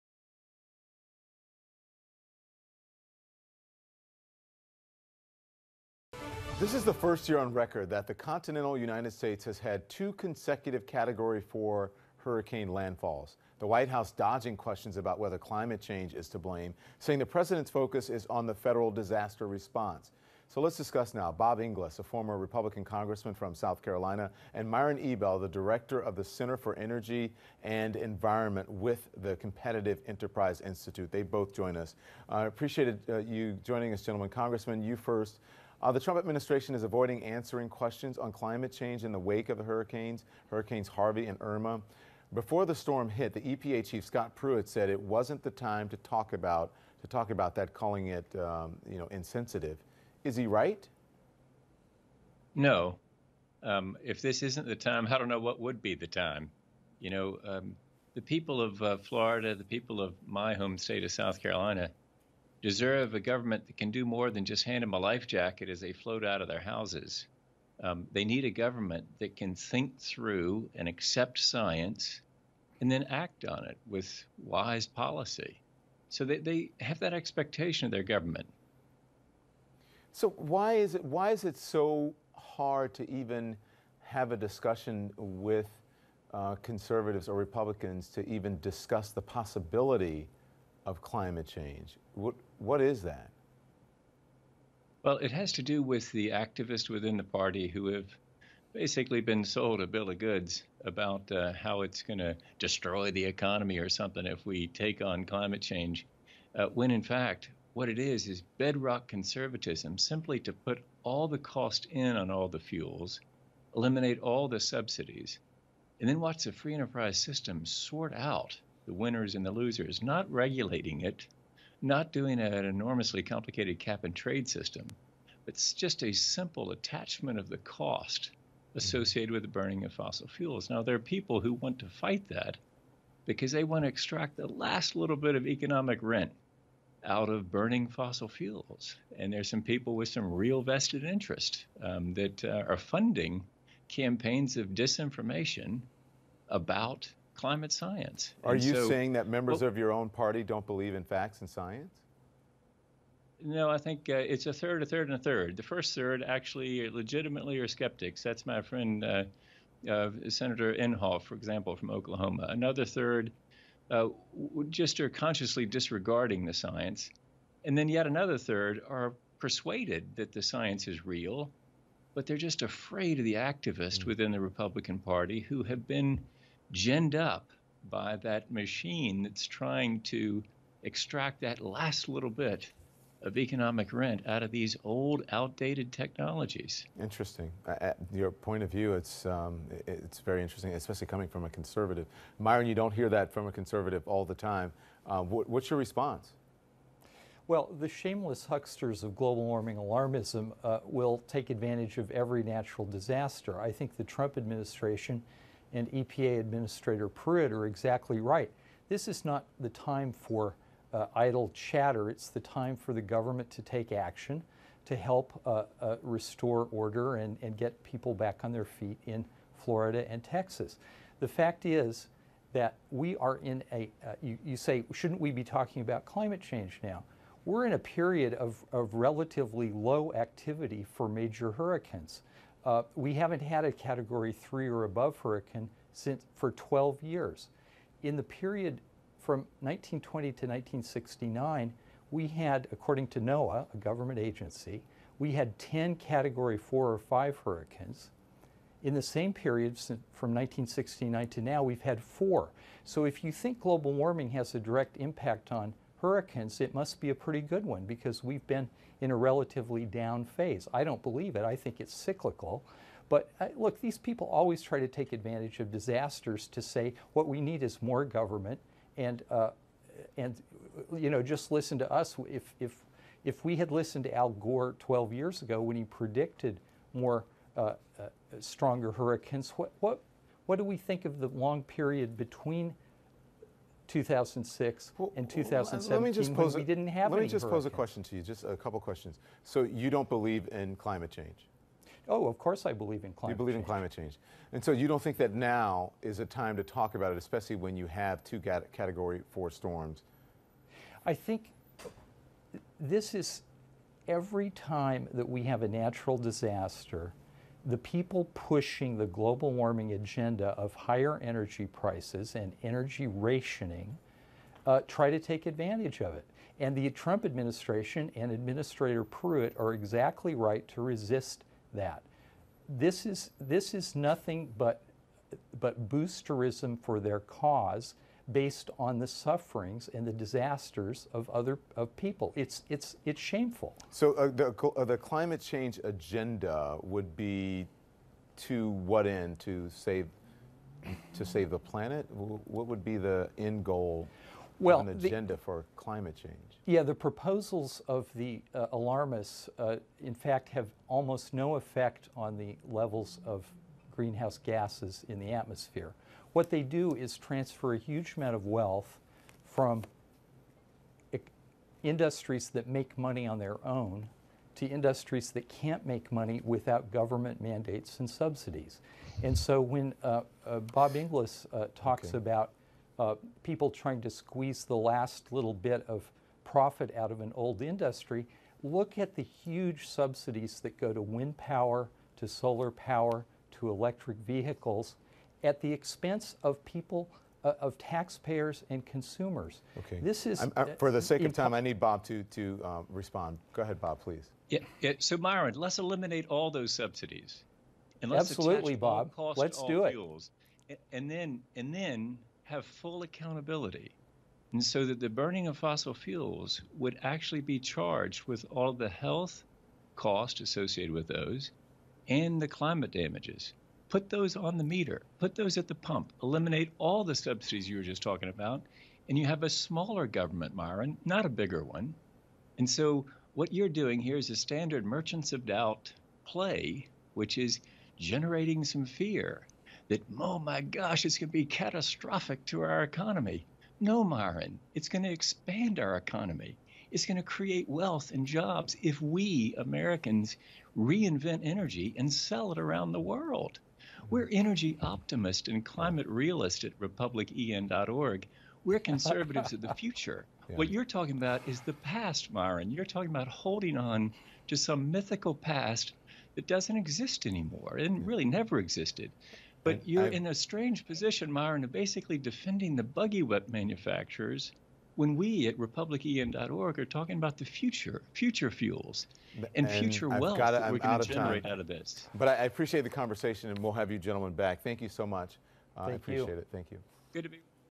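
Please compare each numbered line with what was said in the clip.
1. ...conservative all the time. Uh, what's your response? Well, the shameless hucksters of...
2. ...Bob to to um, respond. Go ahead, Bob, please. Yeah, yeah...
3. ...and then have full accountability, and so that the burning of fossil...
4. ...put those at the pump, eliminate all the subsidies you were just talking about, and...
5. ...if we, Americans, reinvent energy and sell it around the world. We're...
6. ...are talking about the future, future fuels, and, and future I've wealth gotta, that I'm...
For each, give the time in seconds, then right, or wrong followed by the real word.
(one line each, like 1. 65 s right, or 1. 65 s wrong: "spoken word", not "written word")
1. 193 s right
2. 391 s right
3. 401 s right
4. 415 s right
5. 438 s right
6. 466 s right.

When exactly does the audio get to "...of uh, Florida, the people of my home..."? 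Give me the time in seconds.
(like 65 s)
58 s.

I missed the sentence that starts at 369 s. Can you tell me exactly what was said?
And so when uh, uh, Bob Inglis uh, talks okay.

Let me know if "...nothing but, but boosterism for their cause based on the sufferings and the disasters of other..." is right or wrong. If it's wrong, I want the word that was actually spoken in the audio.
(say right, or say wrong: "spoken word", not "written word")
right.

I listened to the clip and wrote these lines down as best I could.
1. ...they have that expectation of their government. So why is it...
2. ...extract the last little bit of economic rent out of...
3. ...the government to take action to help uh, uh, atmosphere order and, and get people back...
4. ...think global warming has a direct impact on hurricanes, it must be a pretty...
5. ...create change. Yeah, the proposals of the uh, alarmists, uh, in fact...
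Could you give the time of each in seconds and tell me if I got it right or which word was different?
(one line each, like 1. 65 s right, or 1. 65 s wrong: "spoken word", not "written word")
1. 76 s right
2. 133 s right
3. 212 s wrong: "restore", not "atmosphere"
4. 253 s right
5. 345 s wrong: "climate", not "create".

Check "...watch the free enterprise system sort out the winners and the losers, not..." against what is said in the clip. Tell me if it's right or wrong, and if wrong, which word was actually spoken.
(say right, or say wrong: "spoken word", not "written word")
right.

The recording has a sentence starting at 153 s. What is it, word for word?
No, I think uh, it's a third, a third, and a third.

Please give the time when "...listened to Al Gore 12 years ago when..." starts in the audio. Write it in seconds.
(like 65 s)
273 s.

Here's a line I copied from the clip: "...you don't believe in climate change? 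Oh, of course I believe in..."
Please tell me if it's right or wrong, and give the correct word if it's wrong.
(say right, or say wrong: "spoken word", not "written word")
right.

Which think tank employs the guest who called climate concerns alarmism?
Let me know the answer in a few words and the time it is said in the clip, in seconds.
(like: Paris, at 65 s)
Competitive Enterprise Institute, at 29 s.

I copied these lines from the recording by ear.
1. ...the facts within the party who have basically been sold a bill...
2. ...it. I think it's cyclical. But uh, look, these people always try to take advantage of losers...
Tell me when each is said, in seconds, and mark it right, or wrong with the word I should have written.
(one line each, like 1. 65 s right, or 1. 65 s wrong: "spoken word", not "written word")
1. 96 s wrong: "activists", not "facts"
2. 261 s wrong: "disasters", not "losers".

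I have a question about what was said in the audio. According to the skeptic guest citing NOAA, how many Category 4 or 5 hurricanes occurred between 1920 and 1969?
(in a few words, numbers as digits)
10.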